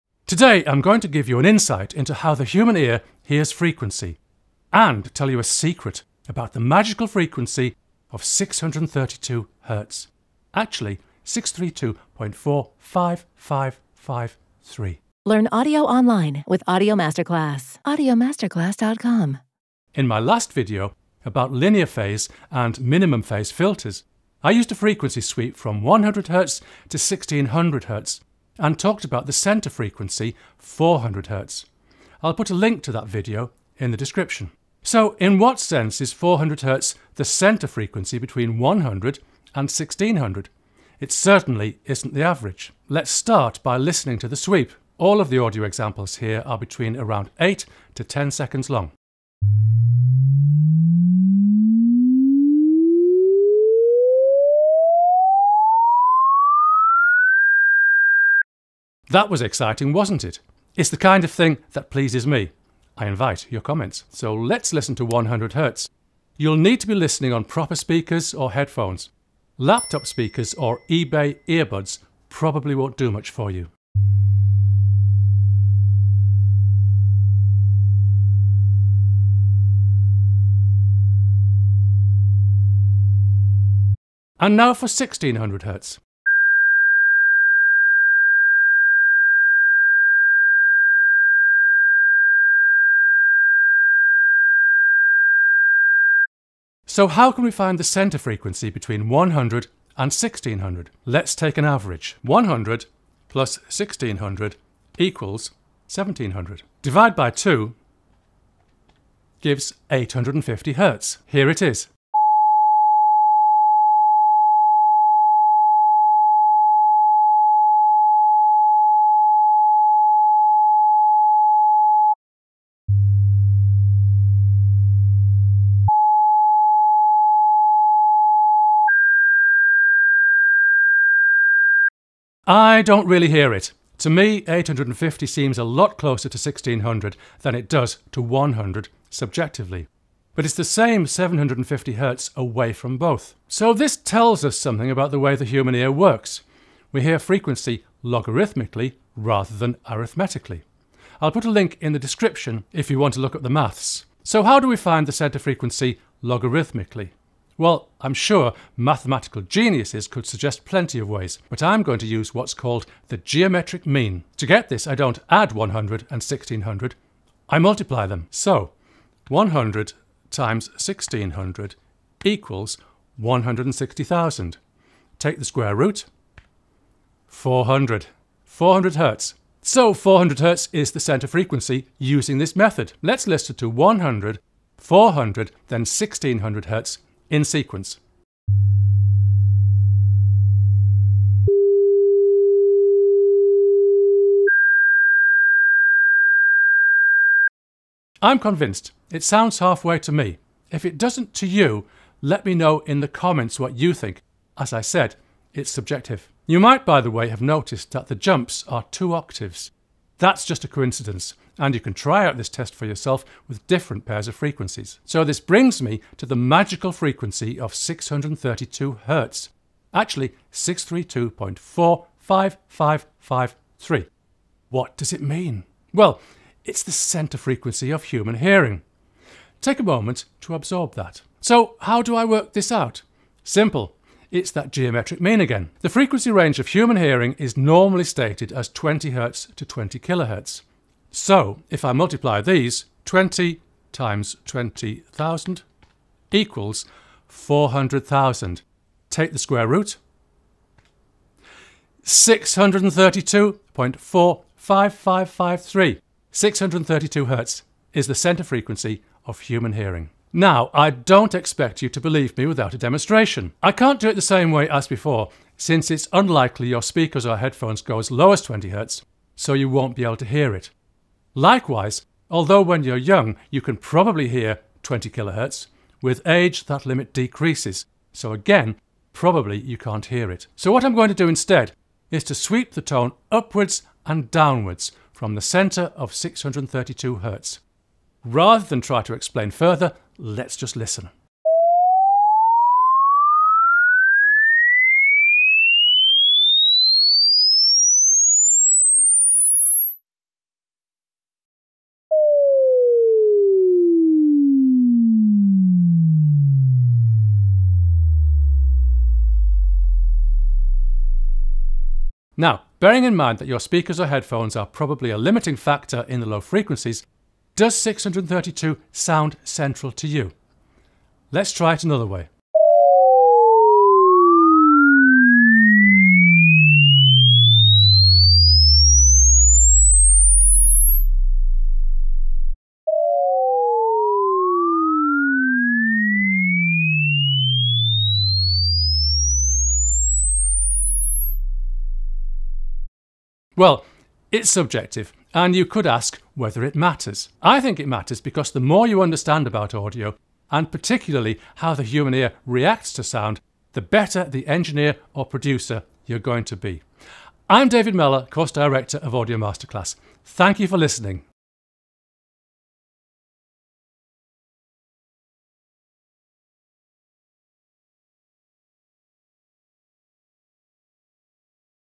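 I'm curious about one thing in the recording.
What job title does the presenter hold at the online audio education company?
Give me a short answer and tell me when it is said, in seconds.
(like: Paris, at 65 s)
Course Director, at 358 s.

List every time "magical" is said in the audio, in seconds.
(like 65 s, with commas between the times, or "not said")
6 s, 216 s.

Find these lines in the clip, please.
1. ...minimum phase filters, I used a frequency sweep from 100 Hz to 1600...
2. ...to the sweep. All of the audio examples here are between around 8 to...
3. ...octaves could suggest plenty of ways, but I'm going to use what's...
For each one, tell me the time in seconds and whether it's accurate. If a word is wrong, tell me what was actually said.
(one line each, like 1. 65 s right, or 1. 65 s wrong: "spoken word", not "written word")
1. 22 s right
2. 44 s right
3. 159 s wrong: "geniuses", not "octaves".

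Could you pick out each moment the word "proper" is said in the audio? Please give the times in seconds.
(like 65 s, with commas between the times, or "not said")
67 s.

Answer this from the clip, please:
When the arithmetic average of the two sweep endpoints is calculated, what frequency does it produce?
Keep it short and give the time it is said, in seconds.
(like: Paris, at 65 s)
850 Hz, at 109 s.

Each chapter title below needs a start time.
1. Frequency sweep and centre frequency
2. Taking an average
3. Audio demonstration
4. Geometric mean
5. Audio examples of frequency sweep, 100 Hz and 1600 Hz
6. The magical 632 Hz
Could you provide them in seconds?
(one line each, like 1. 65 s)
1. 19 s
2. 96 s
3. 260 s
4. 153 s
5. 48 s
6. 215 s.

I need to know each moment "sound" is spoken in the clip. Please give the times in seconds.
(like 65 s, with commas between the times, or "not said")
199 s, 318 s, 353 s.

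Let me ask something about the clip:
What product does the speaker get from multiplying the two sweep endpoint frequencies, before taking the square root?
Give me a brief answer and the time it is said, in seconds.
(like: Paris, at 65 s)
160,000, at 173 s.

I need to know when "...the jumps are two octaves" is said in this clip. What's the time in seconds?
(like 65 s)
208 s.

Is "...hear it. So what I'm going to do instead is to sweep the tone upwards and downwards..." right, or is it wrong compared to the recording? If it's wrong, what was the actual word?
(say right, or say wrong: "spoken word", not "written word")
right.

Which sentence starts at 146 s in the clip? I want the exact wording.
We hear frequency logarithmically rather than arithmetically.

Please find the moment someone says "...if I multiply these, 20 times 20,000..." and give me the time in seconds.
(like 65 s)
241 s.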